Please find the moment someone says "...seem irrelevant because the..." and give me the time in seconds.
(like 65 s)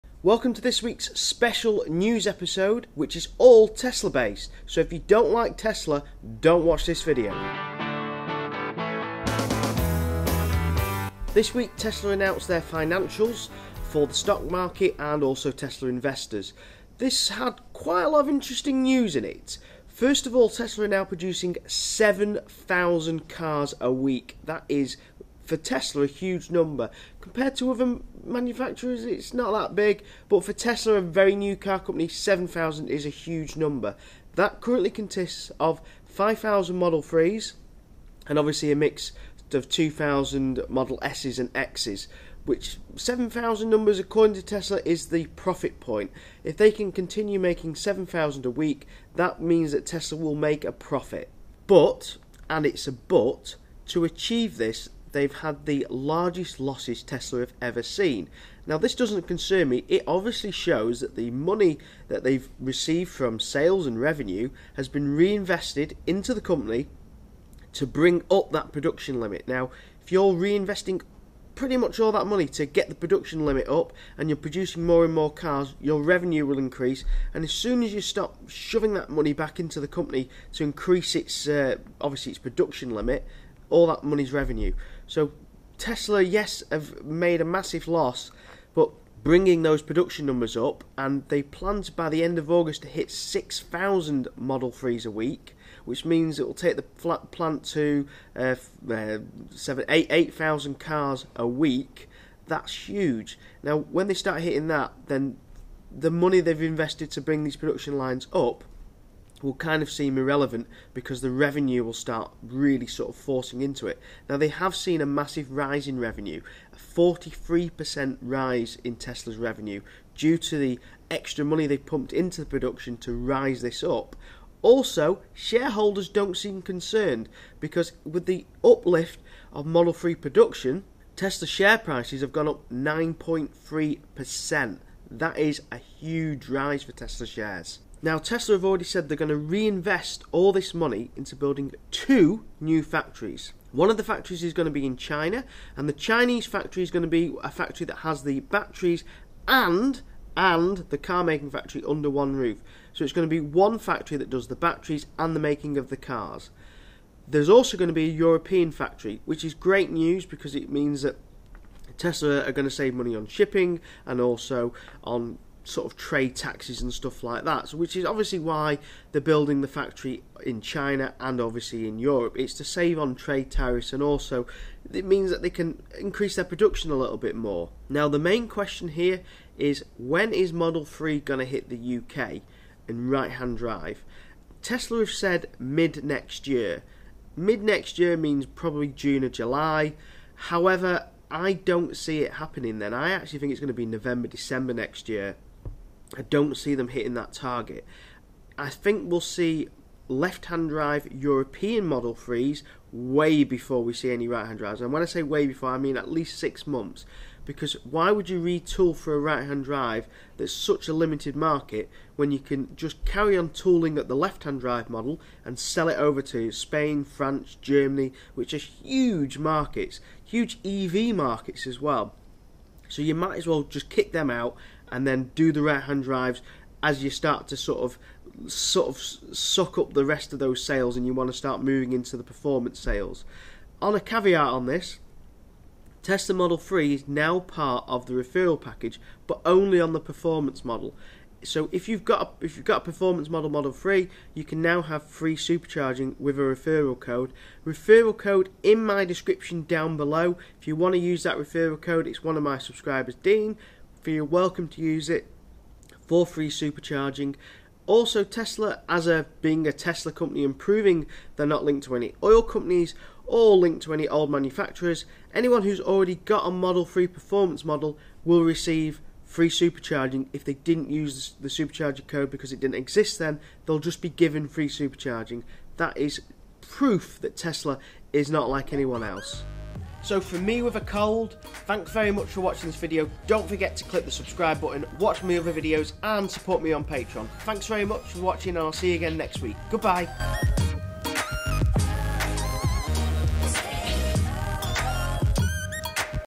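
109 s.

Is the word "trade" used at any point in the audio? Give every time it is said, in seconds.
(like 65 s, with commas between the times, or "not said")
165 s, 173 s.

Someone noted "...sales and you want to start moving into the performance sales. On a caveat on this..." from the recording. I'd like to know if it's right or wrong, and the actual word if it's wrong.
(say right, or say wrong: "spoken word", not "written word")
right.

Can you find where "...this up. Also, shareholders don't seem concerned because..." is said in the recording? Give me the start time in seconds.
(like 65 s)
123 s.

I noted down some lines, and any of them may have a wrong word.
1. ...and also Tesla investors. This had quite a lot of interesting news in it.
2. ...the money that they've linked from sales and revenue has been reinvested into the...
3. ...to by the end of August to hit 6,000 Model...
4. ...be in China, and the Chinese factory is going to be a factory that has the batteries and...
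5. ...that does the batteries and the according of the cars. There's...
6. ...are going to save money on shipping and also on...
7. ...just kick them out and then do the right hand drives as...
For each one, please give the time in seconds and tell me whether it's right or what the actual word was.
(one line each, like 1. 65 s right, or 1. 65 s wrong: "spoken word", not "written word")
1. 14 s right
2. 61 s wrong: "received", not "linked"
3. 91 s right
4. 144 s right
5. 154 s wrong: "making", not "according"
6. 162 s right
7. 223 s right.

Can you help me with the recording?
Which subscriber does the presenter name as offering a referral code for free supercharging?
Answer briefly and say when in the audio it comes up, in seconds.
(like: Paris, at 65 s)
Dean, at 253 s.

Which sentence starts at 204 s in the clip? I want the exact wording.
And when I say way before, I mean at least six months.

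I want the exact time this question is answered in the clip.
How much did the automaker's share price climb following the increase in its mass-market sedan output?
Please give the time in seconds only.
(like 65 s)
132 s.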